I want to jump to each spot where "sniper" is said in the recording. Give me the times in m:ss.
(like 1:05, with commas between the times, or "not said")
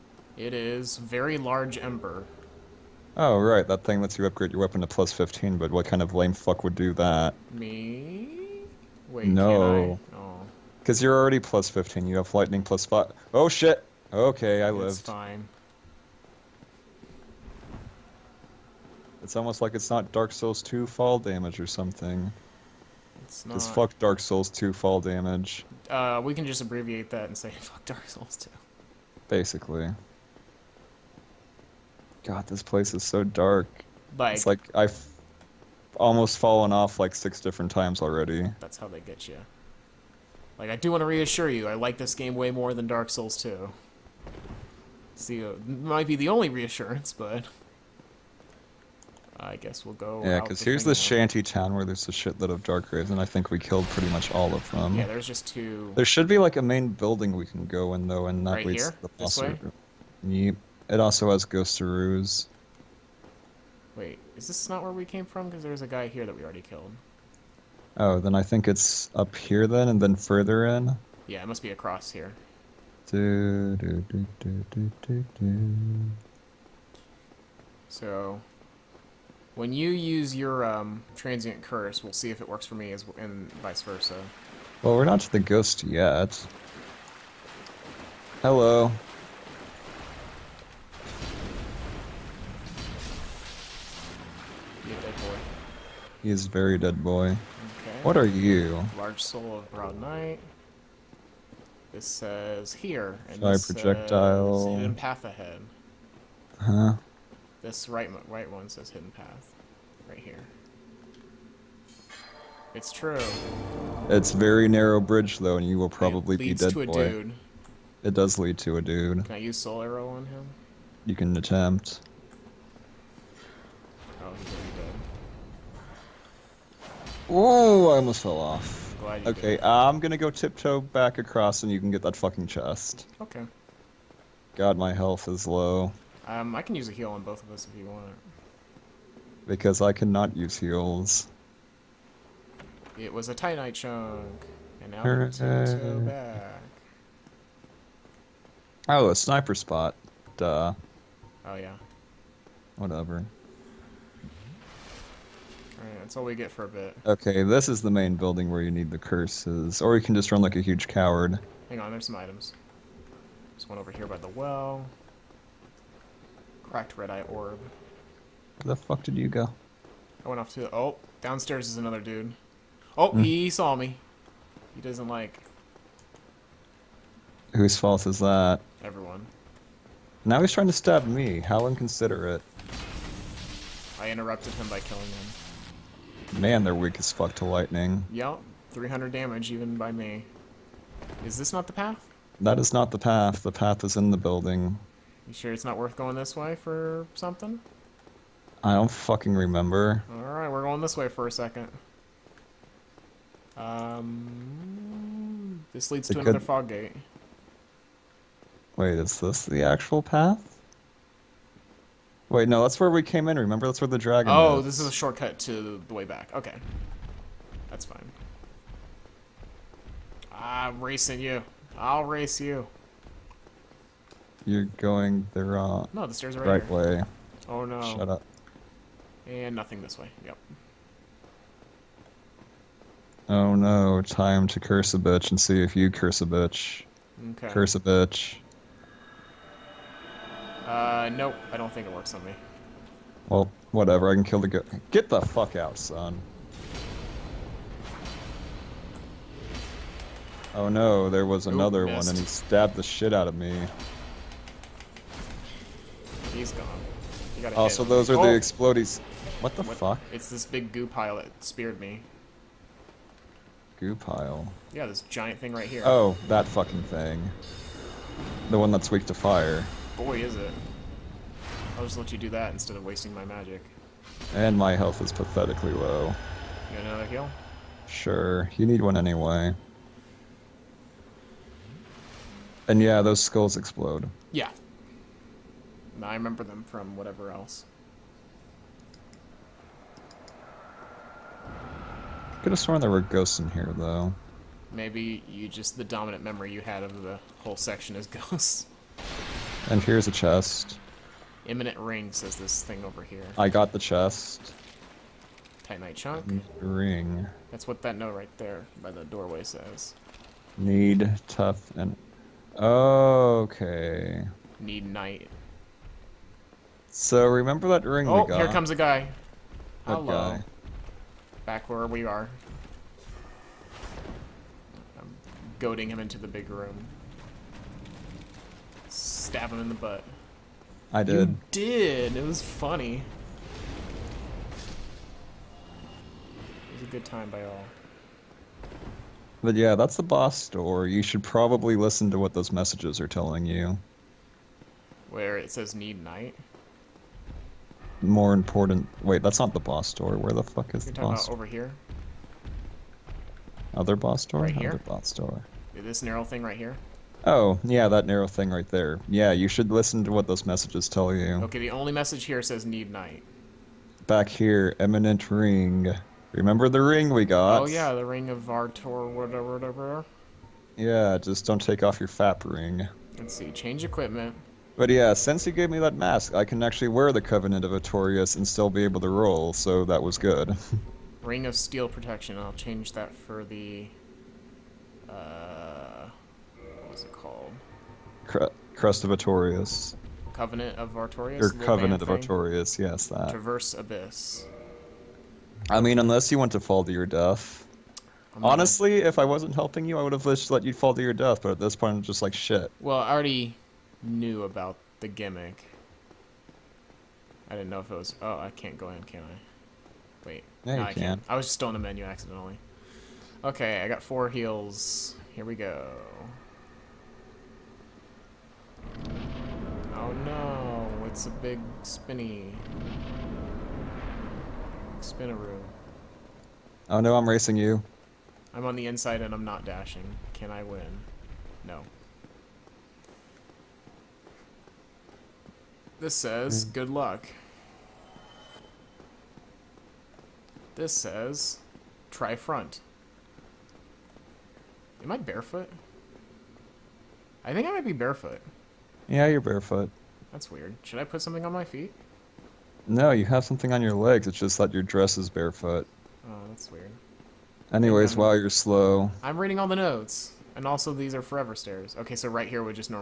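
2:29.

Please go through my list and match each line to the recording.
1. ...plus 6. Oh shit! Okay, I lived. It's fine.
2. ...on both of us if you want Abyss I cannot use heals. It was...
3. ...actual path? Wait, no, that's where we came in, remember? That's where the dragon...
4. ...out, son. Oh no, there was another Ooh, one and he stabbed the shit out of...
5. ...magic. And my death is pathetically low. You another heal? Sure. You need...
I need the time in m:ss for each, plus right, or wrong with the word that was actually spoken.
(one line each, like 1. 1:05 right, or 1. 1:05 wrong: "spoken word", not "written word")
1. 0:12 wrong: "5", not "6"
2. 2:17 wrong: "Because", not "Abyss"
3. 3:29 right
4. 4:05 right
5. 4:33 wrong: "health", not "death".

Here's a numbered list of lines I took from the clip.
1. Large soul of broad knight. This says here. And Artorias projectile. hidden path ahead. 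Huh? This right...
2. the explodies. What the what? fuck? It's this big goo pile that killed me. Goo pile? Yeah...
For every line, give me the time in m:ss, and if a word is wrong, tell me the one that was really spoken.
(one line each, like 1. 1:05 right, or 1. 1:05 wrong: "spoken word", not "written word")
1. 1:38 wrong: "Shy", not "Artorias"
2. 4:18 wrong: "speared", not "killed".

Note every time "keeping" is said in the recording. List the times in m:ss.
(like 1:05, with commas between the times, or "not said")
not said.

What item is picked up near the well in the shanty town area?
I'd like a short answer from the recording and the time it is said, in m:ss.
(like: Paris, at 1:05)
Cracked red eye orb, at 2:46.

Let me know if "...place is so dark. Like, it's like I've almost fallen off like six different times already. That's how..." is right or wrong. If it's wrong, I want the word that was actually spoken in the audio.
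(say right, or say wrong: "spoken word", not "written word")
right.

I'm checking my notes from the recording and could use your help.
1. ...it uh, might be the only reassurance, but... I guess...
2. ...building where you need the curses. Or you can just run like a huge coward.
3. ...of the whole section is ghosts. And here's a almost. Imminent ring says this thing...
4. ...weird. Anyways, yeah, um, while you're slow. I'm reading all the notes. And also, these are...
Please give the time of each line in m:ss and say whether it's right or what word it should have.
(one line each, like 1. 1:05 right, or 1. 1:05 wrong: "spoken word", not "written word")
1. 0:45 right
2. 2:38 right
3. 4:56 wrong: "chest", not "almost"
4. 7:36 right.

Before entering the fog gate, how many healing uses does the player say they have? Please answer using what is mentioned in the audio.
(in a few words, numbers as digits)
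4.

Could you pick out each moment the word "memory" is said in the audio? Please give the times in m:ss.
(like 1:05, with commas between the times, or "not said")
4:56.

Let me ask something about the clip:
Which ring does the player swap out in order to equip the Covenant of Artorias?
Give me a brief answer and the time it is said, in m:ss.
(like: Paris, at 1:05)
Ring of Steel Protection, at 6:21.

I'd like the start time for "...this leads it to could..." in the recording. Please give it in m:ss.
3:25.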